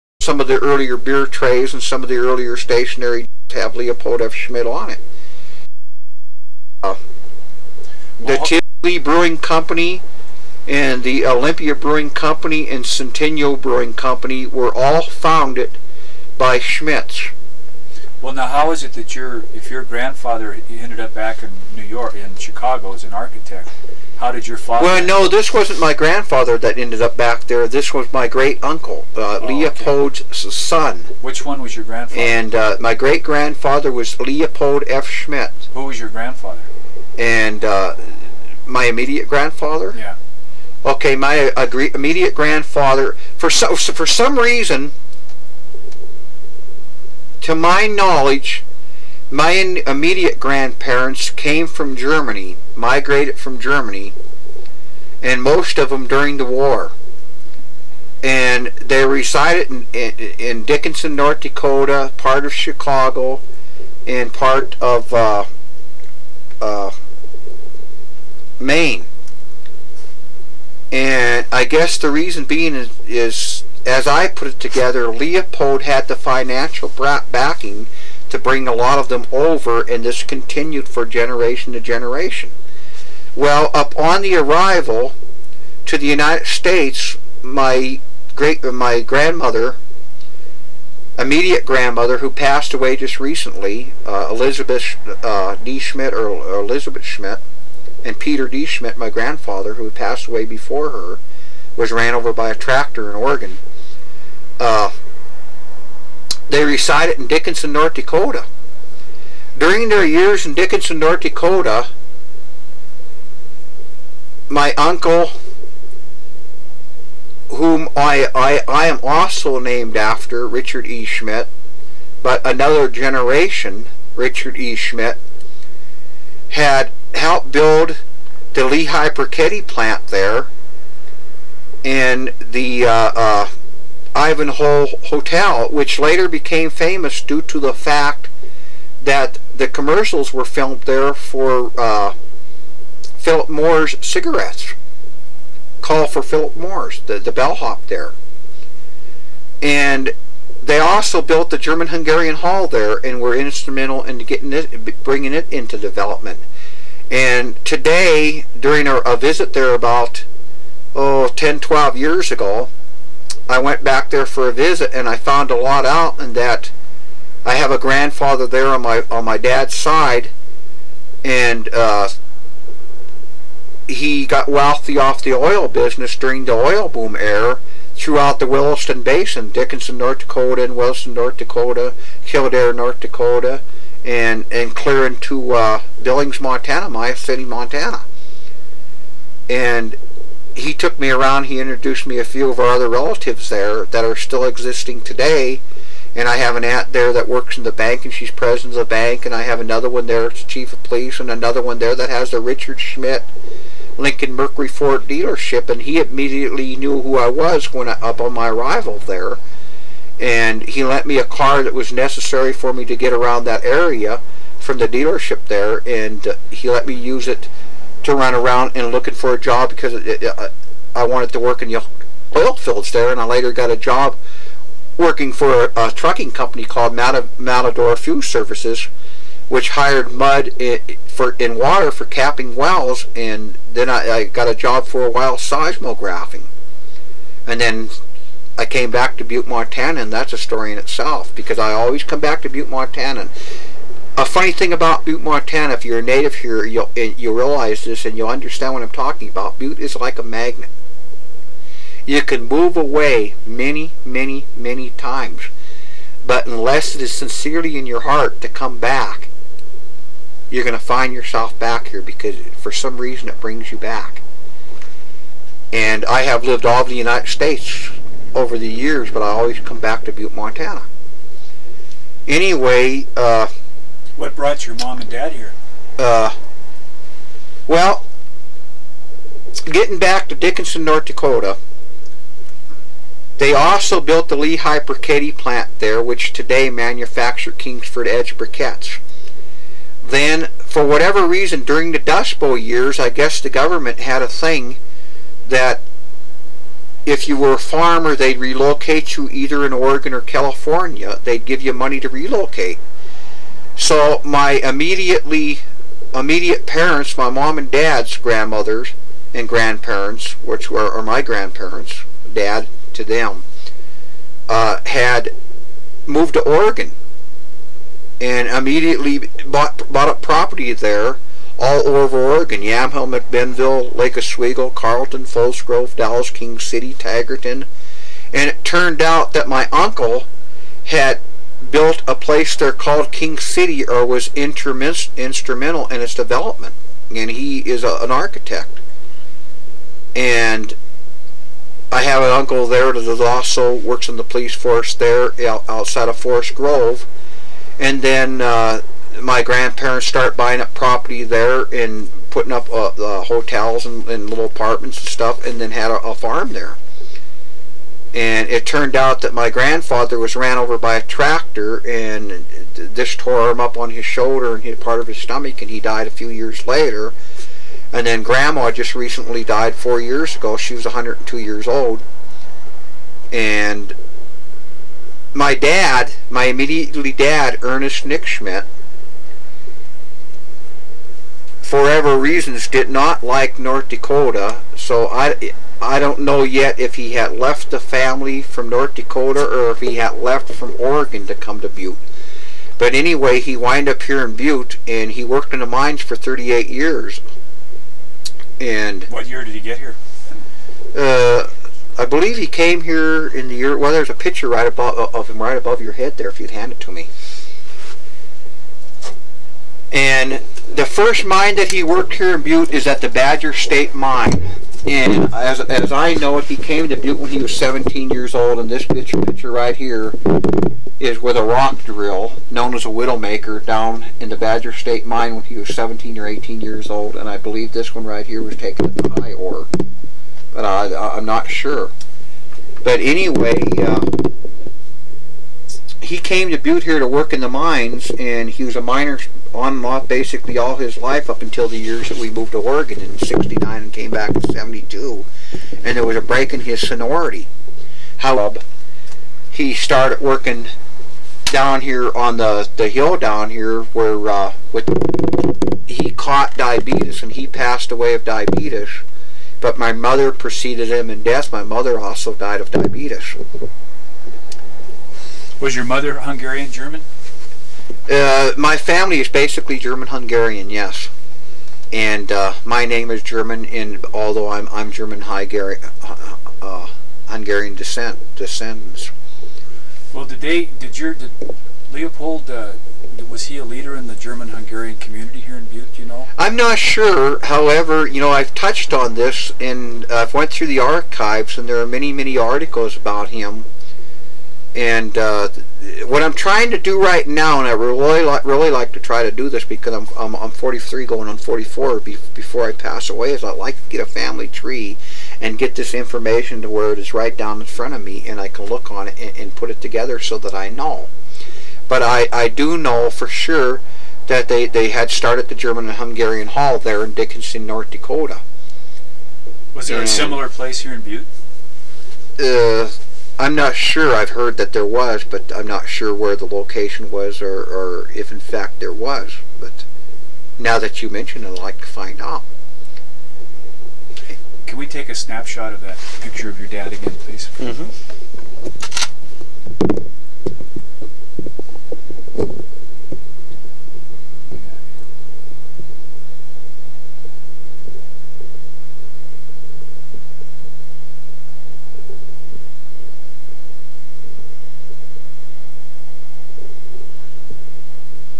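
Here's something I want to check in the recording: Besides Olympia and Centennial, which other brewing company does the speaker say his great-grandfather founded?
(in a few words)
Well, Brewing Company.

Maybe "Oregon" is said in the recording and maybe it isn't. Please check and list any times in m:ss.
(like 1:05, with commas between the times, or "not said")
1:43, 4:59, 5:16, 5:22, 6:30, 7:22.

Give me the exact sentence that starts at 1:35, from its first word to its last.
Schmidt or, or Elizabeth Schmidt, and Peter D.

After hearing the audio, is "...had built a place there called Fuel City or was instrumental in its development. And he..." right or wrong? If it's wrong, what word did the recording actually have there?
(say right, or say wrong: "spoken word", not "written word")
wrong: "King", not "Fuel".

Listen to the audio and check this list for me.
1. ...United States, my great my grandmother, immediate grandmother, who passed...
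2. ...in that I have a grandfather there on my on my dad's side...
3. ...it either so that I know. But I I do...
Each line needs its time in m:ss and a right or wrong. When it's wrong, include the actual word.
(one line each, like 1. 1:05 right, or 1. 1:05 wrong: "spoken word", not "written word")
1. 1:26 right
2. 2:46 right
3. 8:29 wrong: "together", not "either".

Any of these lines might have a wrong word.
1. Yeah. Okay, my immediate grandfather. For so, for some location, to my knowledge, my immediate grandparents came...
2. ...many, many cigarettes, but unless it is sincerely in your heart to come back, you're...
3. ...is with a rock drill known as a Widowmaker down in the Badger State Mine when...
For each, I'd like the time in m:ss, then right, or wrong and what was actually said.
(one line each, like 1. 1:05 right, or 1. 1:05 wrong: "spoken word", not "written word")
1. 0:39 wrong: "reason", not "location"
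2. 4:14 wrong: "times", not "cigarettes"
3. 7:00 right.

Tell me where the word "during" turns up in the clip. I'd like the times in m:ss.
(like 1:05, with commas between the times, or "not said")
0:56, 1:49, 2:38, 2:56, 4:51.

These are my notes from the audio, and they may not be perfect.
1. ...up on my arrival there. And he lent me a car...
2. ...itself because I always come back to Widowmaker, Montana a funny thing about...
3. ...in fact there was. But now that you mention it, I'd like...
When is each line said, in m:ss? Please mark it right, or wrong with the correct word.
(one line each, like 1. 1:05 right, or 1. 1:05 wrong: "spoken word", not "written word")
1. 3:27 right
2. 4:00 wrong: "Butte", not "Widowmaker"
3. 8:48 right.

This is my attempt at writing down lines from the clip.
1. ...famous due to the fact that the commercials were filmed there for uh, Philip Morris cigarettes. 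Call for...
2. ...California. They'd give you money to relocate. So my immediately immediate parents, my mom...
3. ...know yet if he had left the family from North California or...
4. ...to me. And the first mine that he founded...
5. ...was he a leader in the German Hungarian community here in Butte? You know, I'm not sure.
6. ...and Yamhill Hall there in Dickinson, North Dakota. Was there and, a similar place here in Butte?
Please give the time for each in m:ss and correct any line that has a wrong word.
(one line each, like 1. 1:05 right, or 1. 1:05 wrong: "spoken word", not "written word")
1. 2:16 right
2. 5:00 right
3. 6:26 wrong: "Dakota", not "California"
4. 6:46 wrong: "worked", not "founded"
5. 8:03 right
6. 8:35 wrong: "Hungarian", not "Yamhill".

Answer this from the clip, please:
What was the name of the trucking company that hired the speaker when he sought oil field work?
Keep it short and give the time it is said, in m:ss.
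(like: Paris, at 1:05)
Matador Fuel Services, at 3:46.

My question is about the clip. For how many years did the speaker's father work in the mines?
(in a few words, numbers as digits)
38.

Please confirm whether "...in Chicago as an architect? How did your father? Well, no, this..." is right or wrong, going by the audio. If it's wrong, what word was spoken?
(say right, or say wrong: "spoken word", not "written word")
right.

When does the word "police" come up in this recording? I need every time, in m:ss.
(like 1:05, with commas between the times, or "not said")
3:20, 5:44.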